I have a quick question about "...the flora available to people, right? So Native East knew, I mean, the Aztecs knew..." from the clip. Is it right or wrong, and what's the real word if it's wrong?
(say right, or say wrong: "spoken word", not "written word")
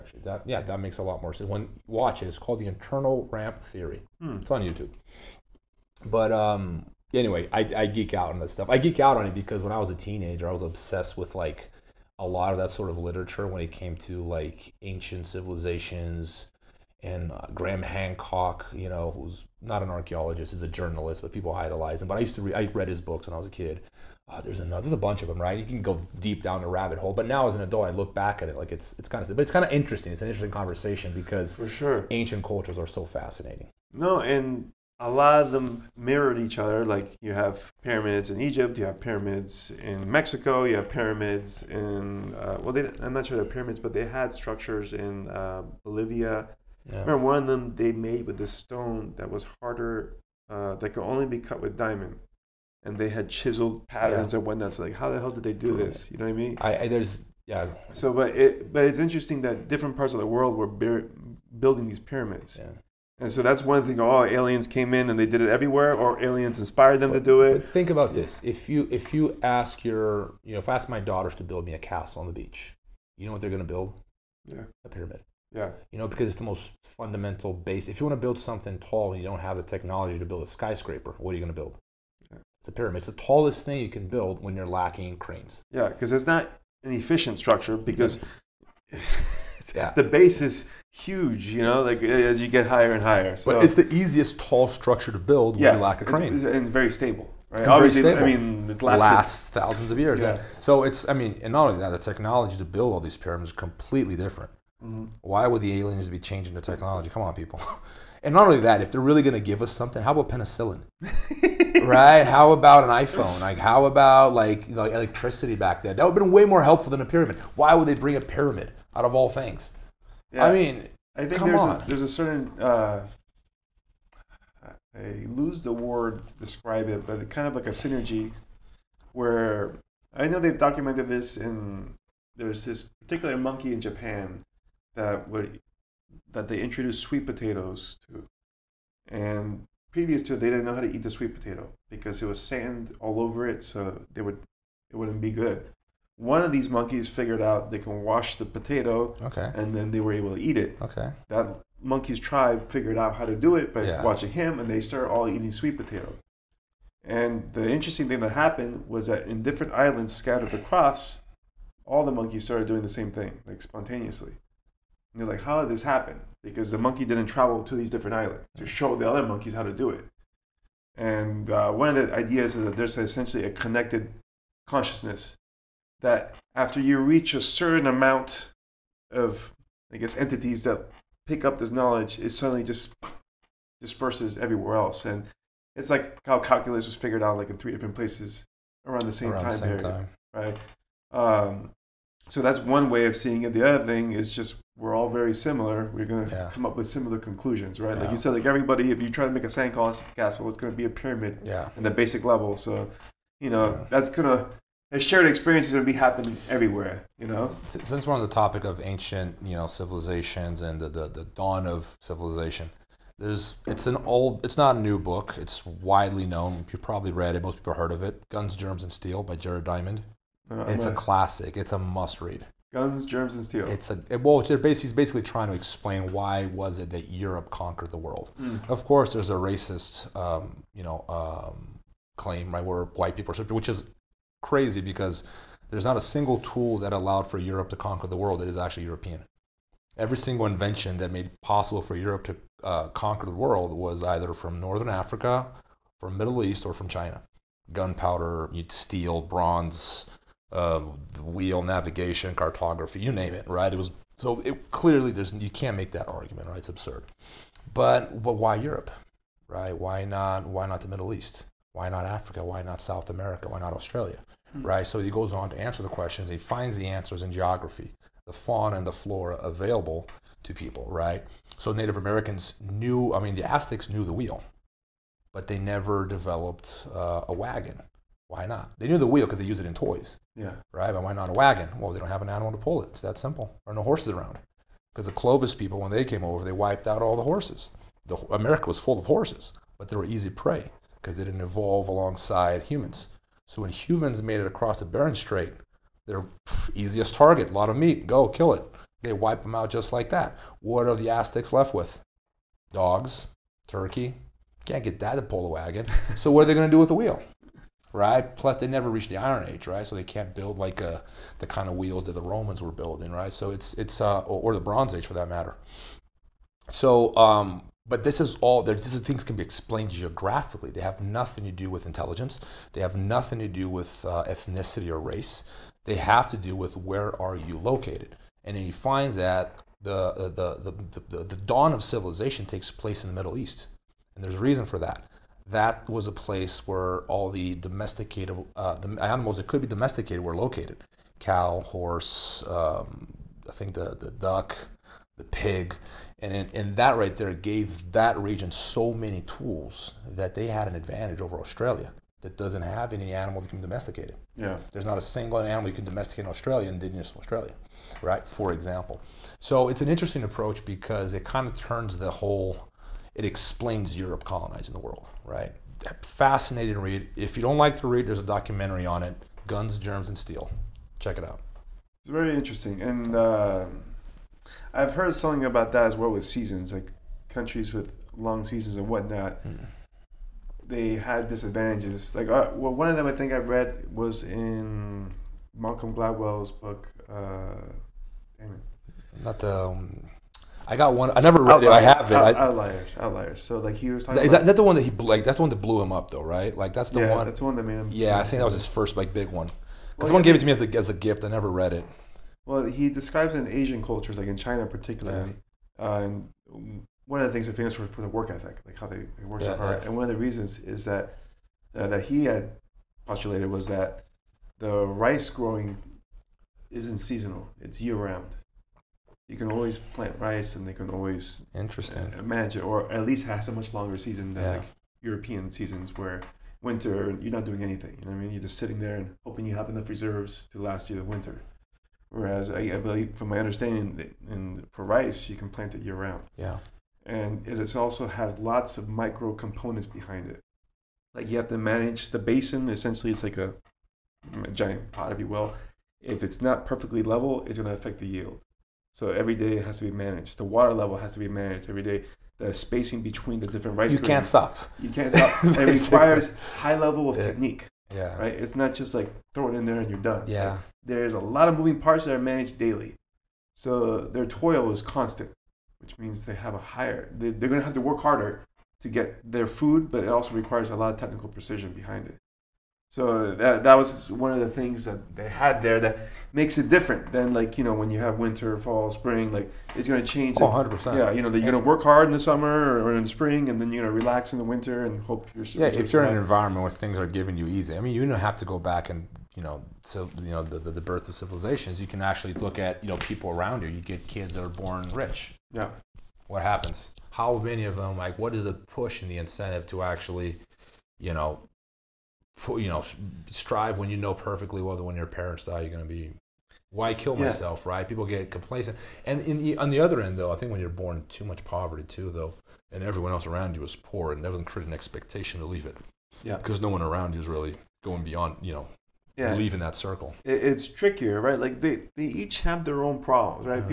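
wrong: "Americans", not "East".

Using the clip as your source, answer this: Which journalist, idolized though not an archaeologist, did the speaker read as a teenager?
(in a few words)
Graham Hancock.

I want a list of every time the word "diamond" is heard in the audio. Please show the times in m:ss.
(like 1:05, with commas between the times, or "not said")
0:51, 3:39.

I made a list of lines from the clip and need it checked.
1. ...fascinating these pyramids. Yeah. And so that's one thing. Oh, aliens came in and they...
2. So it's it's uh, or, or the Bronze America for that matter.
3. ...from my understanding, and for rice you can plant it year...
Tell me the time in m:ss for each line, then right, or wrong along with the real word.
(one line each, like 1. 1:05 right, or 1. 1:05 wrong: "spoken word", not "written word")
1. 1:00 wrong: "building", not "fascinating"
2. 5:13 wrong: "Age", not "America"
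3. 7:13 right.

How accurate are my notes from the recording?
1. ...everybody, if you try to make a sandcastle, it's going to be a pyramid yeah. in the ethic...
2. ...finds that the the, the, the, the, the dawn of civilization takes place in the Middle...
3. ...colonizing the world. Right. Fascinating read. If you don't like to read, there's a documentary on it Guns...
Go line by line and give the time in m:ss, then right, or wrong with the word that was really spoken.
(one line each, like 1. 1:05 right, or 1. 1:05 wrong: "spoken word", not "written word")
1. 3:18 wrong: "basic", not "ethic"
2. 5:28 right
3. 6:04 right.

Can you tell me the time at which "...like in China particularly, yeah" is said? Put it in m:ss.
6:44.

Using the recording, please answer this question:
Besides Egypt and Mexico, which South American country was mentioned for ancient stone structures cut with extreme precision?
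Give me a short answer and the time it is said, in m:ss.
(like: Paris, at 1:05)
Bolivia, at 0:45.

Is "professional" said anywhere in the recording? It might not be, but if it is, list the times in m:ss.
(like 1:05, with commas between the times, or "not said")
not said.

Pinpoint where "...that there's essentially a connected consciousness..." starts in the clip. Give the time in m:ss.
2:52.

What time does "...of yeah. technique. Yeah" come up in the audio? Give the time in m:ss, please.
7:37.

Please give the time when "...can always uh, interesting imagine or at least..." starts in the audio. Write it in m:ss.
7:00.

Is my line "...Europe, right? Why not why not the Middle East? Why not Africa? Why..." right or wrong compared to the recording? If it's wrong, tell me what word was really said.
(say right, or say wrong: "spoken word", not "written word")
right.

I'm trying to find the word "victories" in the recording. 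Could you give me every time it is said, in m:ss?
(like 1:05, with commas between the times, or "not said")
not said.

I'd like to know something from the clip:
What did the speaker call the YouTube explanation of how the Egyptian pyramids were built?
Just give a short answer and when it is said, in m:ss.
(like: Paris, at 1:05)
internal ramp theory, at 0:02.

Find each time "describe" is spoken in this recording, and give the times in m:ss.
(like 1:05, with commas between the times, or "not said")
2:06, 6:42.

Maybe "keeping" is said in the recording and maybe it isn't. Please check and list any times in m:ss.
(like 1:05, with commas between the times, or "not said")
not said.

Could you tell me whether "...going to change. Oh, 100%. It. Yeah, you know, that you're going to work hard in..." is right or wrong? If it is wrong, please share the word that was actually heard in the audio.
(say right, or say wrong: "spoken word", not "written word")
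right.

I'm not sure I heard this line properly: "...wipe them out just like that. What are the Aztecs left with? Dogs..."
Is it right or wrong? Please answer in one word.
right.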